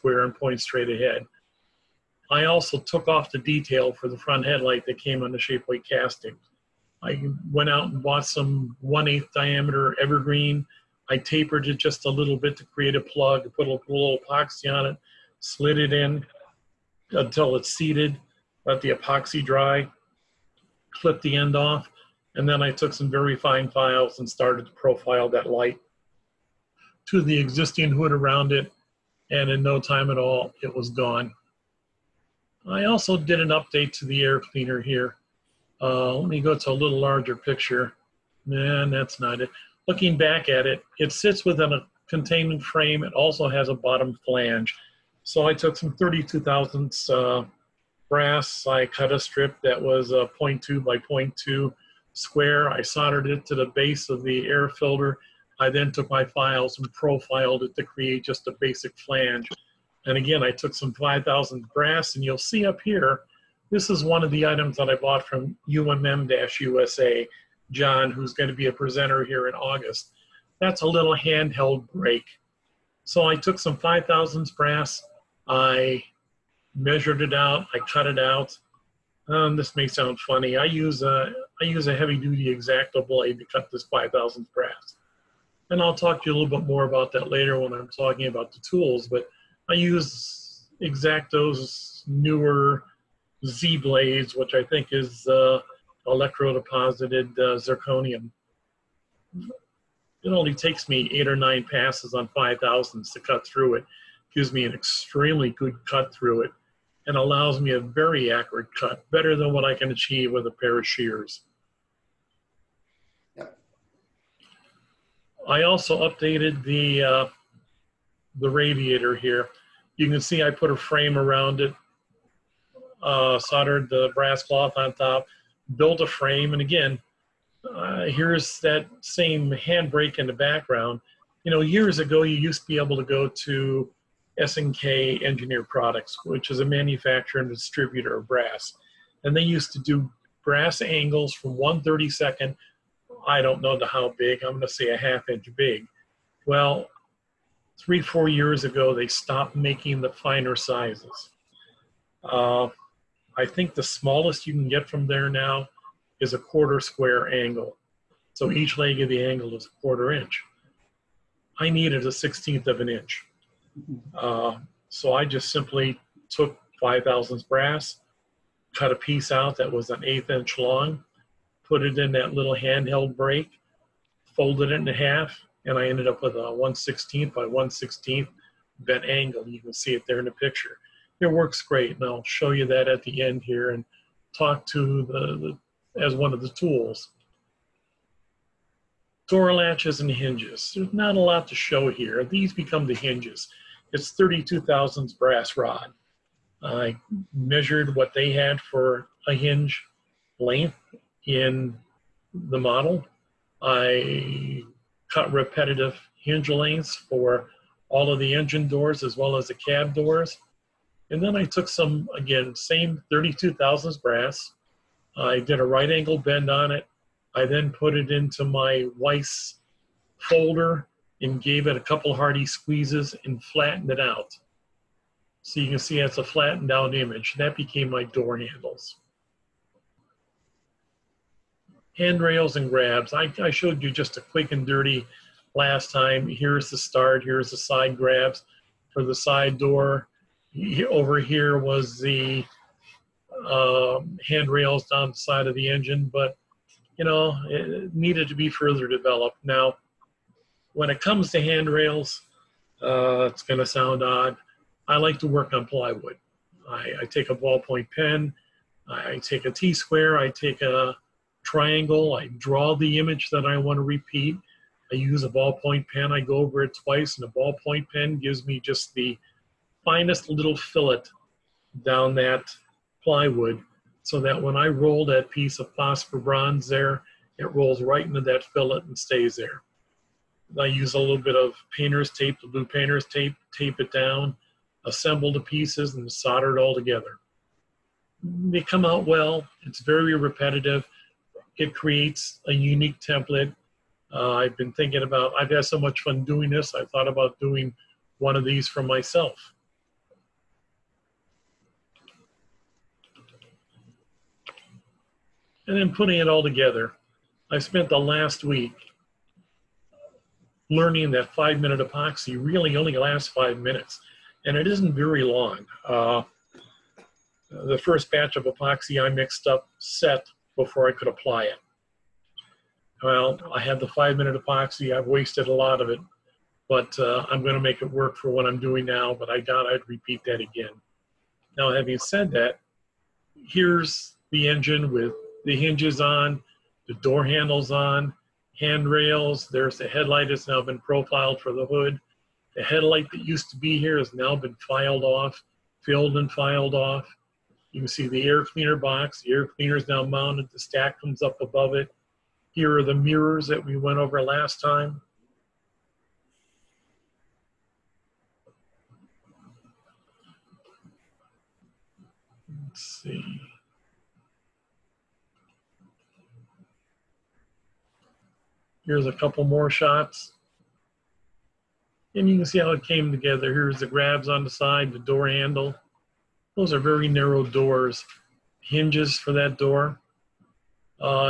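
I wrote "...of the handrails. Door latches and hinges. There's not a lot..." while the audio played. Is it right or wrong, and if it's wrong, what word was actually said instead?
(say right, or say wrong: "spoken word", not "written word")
wrong: "tools", not "handrails".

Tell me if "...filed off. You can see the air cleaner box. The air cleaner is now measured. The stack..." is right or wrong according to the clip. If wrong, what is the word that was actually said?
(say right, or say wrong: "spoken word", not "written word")
wrong: "mounted", not "measured".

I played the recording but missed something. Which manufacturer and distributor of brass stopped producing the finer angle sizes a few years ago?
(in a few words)
SNK Engineer Products.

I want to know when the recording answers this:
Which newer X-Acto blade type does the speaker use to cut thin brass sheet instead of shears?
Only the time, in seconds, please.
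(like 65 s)
93 s.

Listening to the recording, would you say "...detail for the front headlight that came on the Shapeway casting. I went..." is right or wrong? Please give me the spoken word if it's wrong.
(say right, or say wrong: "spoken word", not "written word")
right.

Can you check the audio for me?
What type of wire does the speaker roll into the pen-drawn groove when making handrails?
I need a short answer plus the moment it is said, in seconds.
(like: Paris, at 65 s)
Phosphor bronze, at 275 s.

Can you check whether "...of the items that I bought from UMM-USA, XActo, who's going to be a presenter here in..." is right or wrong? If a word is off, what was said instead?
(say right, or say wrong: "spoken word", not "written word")
wrong: "John", not "XActo".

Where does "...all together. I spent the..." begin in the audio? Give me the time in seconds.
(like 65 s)
306 s.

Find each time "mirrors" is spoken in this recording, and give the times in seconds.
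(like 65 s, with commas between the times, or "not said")
352 s.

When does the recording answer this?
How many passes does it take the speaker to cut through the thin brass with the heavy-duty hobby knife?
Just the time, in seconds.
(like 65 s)
101 s.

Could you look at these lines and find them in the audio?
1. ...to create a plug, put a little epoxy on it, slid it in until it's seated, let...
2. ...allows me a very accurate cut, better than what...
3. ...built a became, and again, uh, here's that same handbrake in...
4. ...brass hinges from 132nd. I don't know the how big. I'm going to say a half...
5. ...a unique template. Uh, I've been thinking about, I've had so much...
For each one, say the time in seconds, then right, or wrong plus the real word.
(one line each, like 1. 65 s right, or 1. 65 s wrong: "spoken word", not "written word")
1. 12 s right
2. 107 s right
3. 125 s wrong: "frame", not "became"
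4. 140 s wrong: "angles", not "hinges"
5. 292 s right.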